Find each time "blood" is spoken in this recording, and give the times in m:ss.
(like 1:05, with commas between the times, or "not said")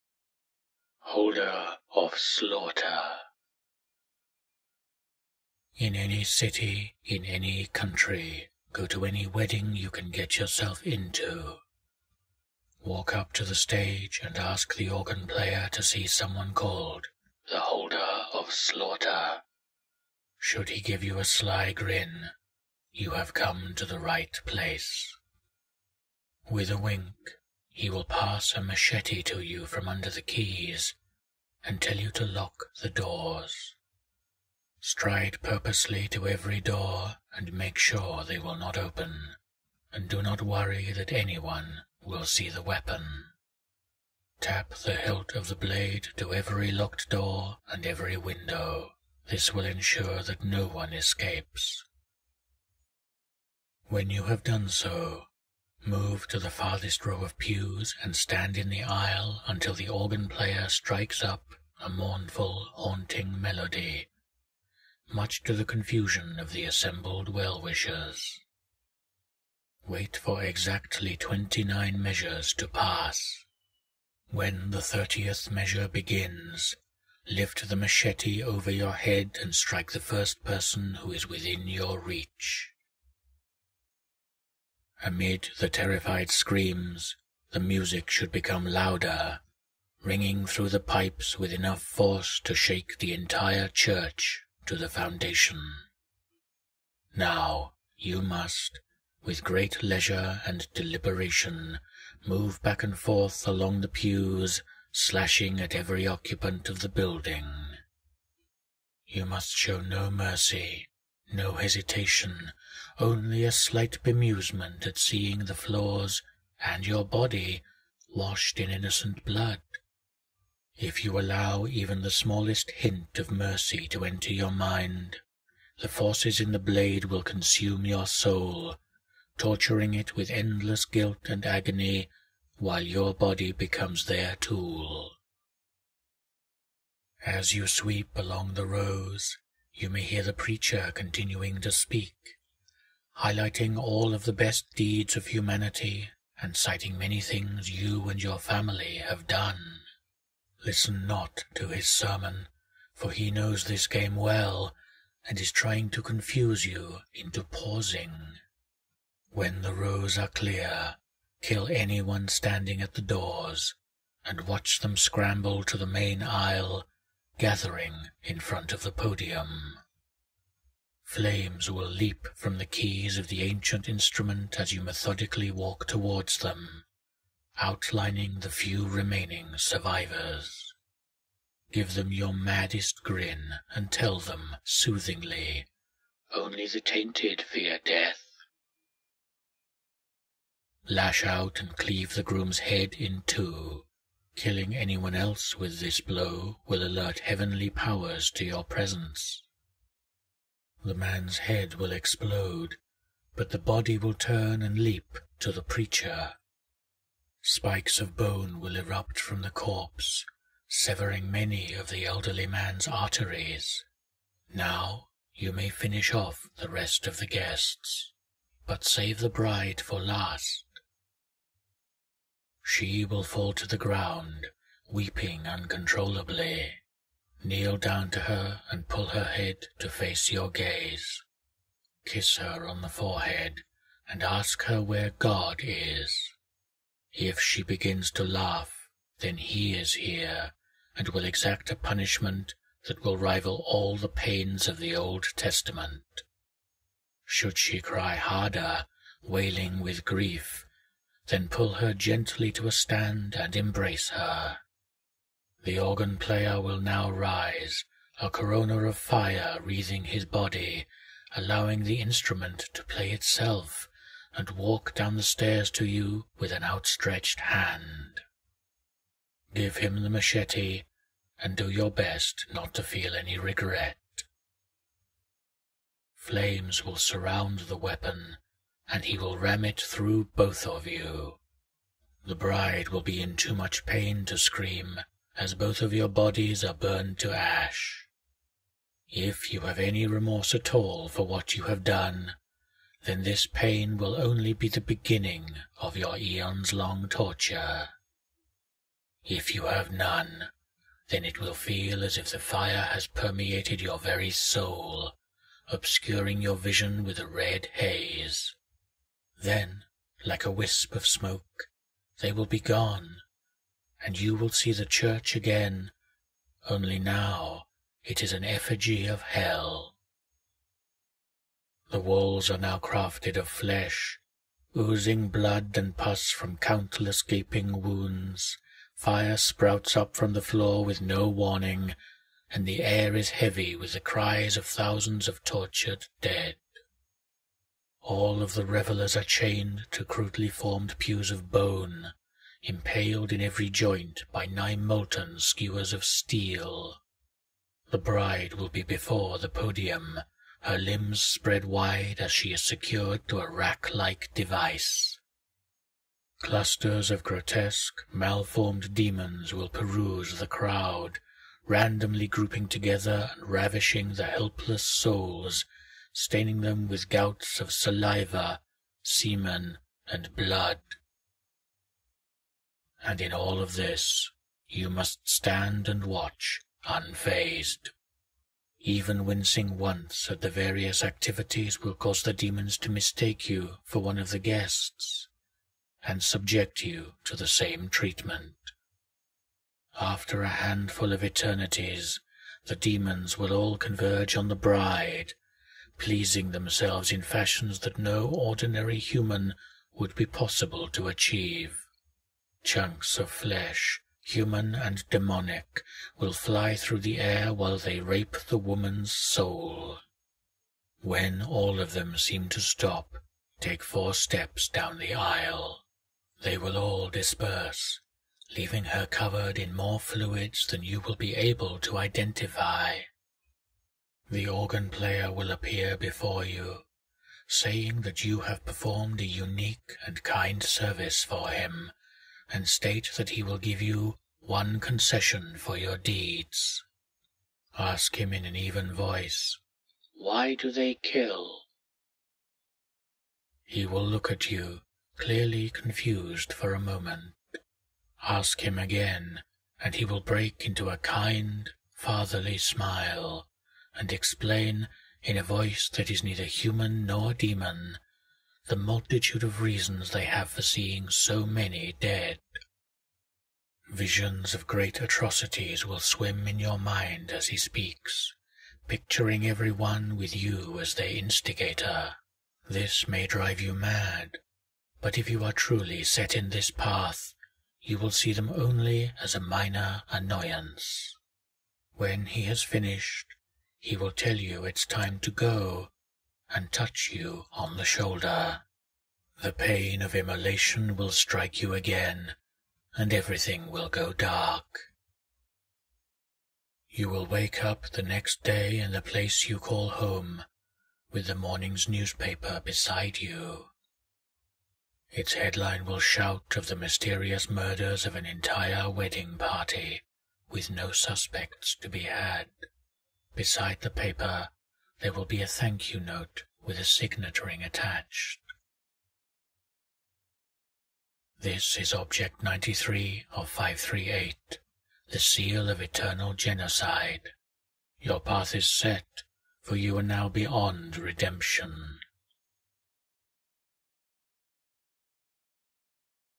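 1:59, 5:25, 6:10.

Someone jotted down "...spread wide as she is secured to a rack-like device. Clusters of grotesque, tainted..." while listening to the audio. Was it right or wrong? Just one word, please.
wrong.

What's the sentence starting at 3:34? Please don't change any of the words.
Now you may finish off the rest of the guests, but save the bride for last.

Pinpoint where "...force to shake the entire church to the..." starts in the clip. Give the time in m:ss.
1:31.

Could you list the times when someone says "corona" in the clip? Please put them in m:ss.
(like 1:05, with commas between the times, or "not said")
4:18.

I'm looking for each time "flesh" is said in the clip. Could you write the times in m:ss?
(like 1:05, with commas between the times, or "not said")
5:23, 6:43.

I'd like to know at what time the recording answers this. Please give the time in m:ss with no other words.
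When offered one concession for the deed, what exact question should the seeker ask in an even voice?
7:20.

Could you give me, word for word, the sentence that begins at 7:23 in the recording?
He will look at you, clearly confused for a moment.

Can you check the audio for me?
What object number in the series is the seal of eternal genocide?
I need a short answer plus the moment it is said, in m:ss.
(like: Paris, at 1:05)
93, at 8:42.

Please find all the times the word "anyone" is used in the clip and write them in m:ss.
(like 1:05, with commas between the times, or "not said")
0:41, 2:41, 3:14.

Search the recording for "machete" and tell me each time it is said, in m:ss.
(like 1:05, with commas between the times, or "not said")
0:28, 1:17, 4:30.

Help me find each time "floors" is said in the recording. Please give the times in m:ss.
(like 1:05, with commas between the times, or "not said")
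1:55, 5:30.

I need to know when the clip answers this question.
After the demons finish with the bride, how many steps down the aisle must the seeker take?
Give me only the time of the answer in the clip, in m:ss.
6:53.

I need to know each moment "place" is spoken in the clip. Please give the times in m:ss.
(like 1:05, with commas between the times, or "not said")
0:24, 8:19.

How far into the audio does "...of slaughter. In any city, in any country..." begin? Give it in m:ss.
0:01.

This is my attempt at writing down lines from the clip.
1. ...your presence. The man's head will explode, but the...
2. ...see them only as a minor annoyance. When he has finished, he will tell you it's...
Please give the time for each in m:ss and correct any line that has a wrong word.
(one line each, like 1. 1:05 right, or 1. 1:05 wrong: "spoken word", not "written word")
1. 3:18 right
2. 7:58 right.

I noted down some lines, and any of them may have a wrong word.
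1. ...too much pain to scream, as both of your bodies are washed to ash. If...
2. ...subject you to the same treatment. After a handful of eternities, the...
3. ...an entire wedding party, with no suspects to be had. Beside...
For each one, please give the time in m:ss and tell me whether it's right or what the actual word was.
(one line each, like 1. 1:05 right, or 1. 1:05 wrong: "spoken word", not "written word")
1. 4:43 wrong: "burned", not "washed"
2. 6:26 right
3. 8:28 right.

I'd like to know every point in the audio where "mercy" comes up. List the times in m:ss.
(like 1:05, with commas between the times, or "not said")
1:50, 2:03.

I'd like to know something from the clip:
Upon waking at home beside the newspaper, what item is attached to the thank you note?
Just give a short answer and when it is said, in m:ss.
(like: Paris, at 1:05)
signet ring, at 8:36.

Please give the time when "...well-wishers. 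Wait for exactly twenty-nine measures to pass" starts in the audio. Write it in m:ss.
1:07.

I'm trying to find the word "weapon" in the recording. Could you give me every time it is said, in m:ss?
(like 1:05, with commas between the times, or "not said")
0:42, 4:37.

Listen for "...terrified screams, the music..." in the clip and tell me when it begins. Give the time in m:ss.
1:25.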